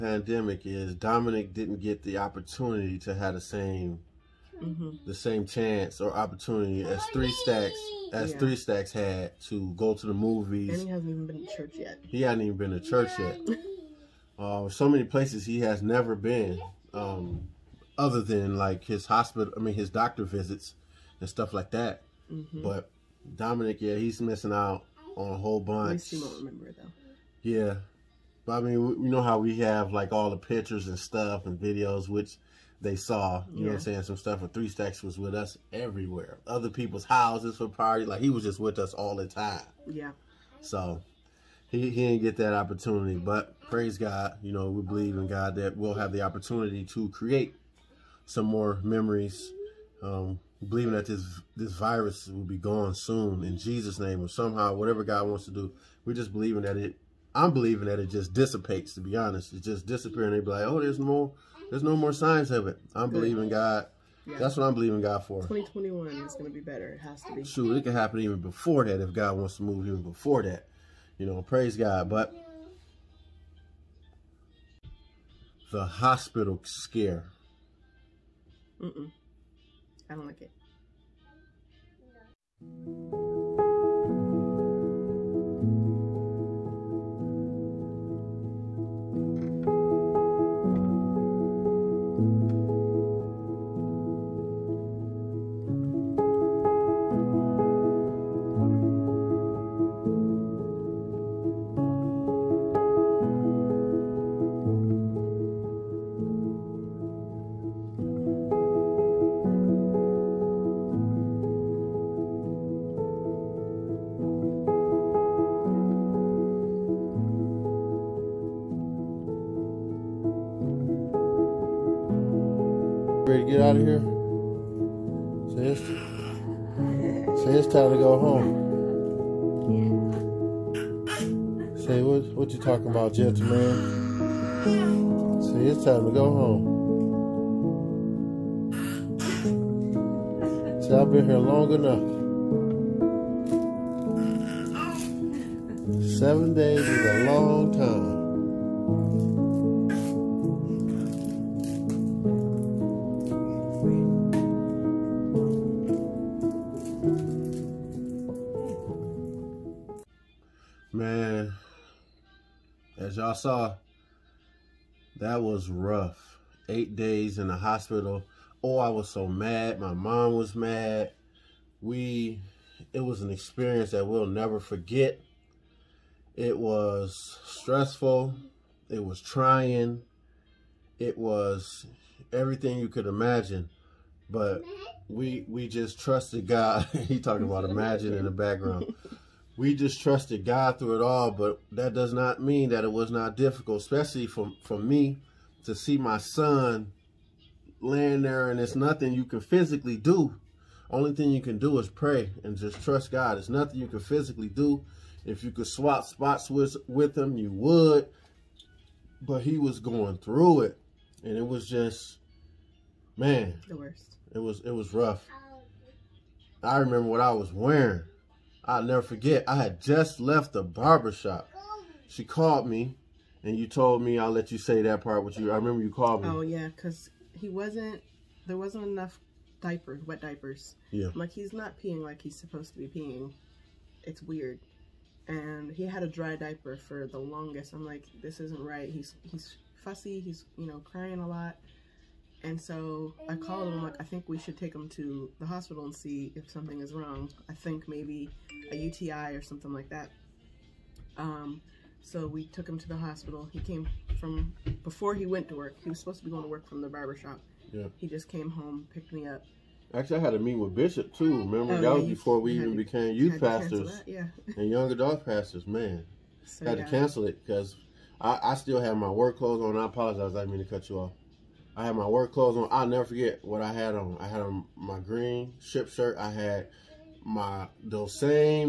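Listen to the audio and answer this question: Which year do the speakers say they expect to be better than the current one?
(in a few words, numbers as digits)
2021.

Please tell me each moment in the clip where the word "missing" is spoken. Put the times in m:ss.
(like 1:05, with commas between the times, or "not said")
0:24.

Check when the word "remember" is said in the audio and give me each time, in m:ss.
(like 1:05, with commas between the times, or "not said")
0:26, 3:36, 3:45, 4:21.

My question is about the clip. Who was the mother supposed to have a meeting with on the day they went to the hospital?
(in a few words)
Bishop.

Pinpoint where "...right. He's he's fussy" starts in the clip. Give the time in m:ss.
3:58.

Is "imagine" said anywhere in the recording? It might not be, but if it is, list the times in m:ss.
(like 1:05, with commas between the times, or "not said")
3:03, 3:07.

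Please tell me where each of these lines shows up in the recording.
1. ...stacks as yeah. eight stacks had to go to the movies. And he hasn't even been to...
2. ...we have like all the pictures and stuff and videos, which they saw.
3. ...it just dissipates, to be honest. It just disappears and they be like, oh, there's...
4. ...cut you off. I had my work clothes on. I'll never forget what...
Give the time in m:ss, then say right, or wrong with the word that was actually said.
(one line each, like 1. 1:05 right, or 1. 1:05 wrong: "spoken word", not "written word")
1. 0:07 wrong: "three", not "eight"
2. 0:29 right
3. 0:57 right
4. 4:30 right.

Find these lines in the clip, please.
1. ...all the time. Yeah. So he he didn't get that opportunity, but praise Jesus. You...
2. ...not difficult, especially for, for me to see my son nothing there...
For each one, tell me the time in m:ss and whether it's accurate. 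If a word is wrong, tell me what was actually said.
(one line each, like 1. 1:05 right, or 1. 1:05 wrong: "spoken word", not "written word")
1. 0:38 wrong: "God", not "Jesus"
2. 3:13 wrong: "laying", not "nothing".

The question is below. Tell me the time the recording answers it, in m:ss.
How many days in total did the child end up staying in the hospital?
2:46.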